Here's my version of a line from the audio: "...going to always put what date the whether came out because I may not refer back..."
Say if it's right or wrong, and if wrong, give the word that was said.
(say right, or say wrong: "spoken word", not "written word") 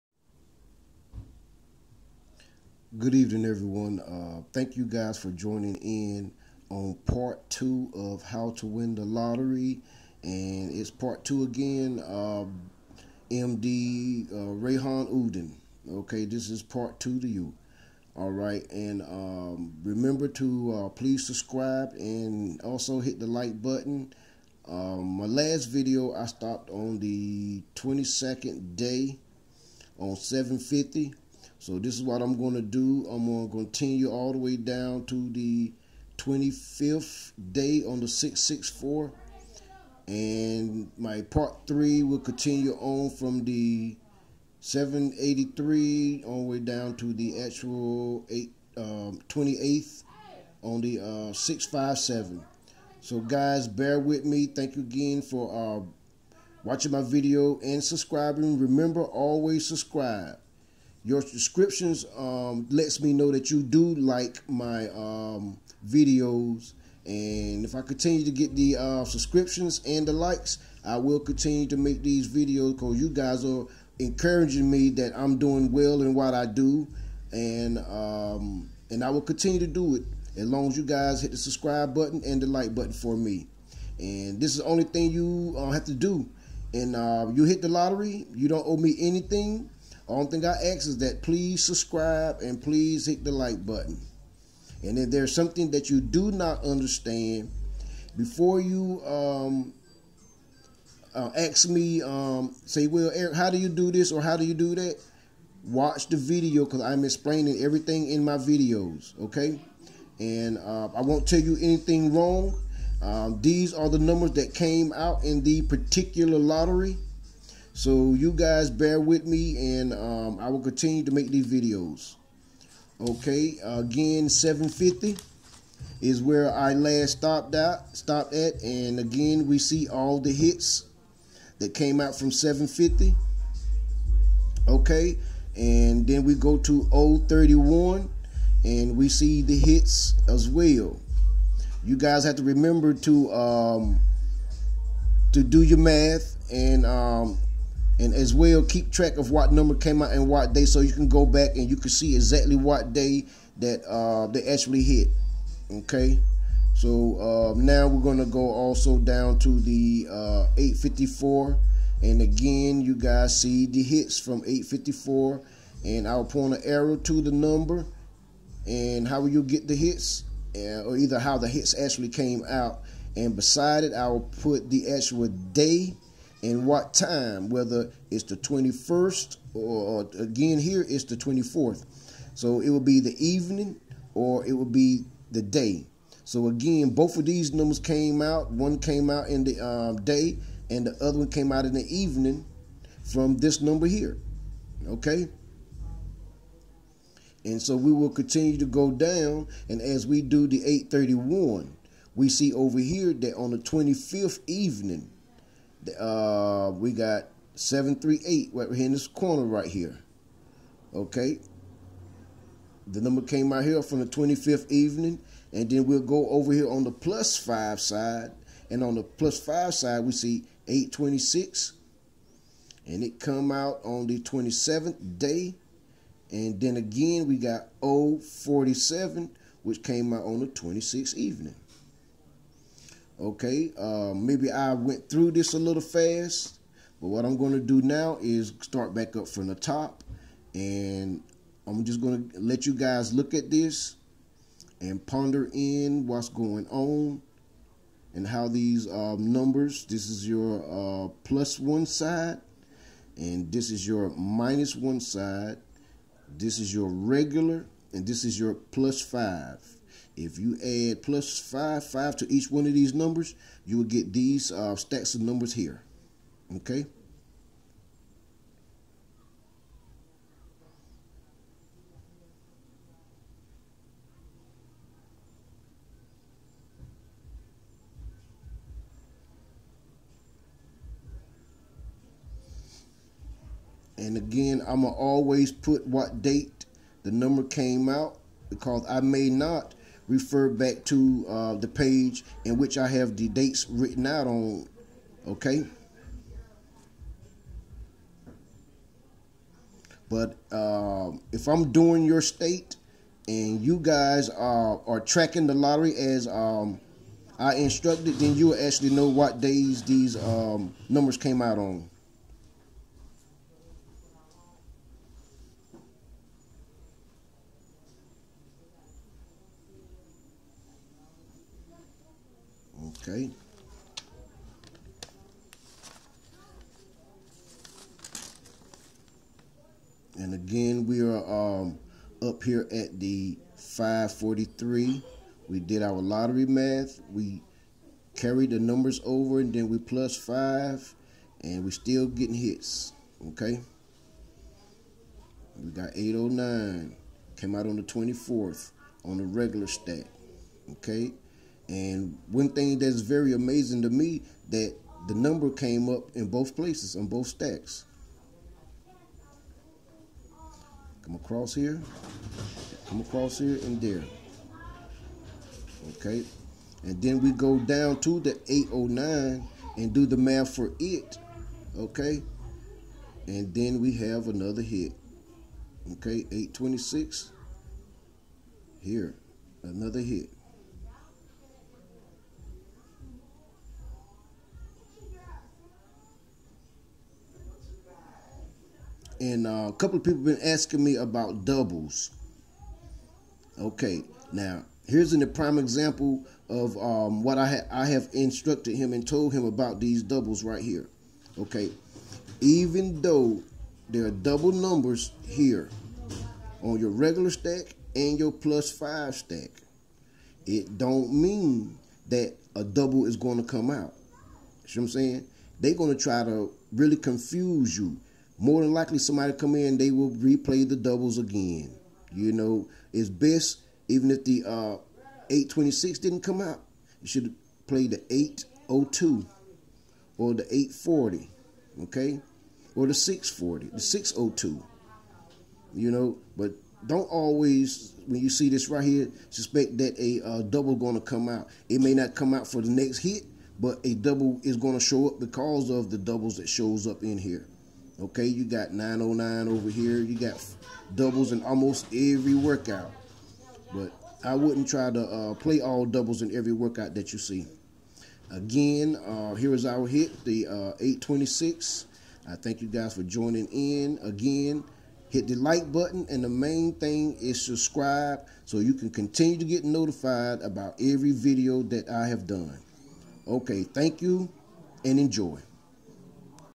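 wrong: "number", not "whether".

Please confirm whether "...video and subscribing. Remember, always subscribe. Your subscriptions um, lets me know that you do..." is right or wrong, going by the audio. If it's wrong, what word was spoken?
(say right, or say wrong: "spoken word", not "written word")
right.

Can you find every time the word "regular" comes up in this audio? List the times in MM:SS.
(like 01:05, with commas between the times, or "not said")
04:16, 05:49, 06:46.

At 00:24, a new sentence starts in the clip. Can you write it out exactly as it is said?
Um, my last video I stopped on the 22nd day on 750 so this is what I'm going to do.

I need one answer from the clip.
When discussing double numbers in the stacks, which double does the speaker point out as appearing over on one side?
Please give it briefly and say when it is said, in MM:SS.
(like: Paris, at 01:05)
909, at 07:28.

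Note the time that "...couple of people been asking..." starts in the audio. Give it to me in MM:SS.
06:29.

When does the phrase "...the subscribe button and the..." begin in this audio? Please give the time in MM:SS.
01:21.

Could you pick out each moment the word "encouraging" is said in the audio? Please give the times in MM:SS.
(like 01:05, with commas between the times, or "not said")
01:13.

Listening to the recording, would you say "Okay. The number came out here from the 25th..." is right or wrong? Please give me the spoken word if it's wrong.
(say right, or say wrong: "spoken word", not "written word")
right.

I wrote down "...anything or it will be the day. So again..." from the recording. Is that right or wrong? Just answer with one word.
wrong.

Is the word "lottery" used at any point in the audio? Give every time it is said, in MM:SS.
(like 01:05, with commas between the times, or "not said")
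00:09, 01:27, 01:56, 05:05, 05:35.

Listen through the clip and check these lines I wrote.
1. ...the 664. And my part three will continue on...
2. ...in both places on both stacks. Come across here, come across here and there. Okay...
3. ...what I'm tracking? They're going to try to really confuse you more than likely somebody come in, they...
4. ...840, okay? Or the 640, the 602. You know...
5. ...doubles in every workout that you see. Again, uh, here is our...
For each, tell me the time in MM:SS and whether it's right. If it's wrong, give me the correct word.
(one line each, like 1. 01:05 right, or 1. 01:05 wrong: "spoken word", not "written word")
1. 00:37 right
2. 05:56 right
3. 06:54 wrong: "saying", not "tracking"
4. 07:10 right
5. 07:35 right.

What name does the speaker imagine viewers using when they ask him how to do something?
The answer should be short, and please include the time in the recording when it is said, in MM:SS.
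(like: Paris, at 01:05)
Eric, at 01:43.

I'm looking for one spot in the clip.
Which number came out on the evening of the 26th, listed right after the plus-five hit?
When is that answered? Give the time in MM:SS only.
03:47.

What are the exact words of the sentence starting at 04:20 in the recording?
If you add plus 5, 5 to each one of these numbers, you will get these uh, stacks of numbers here.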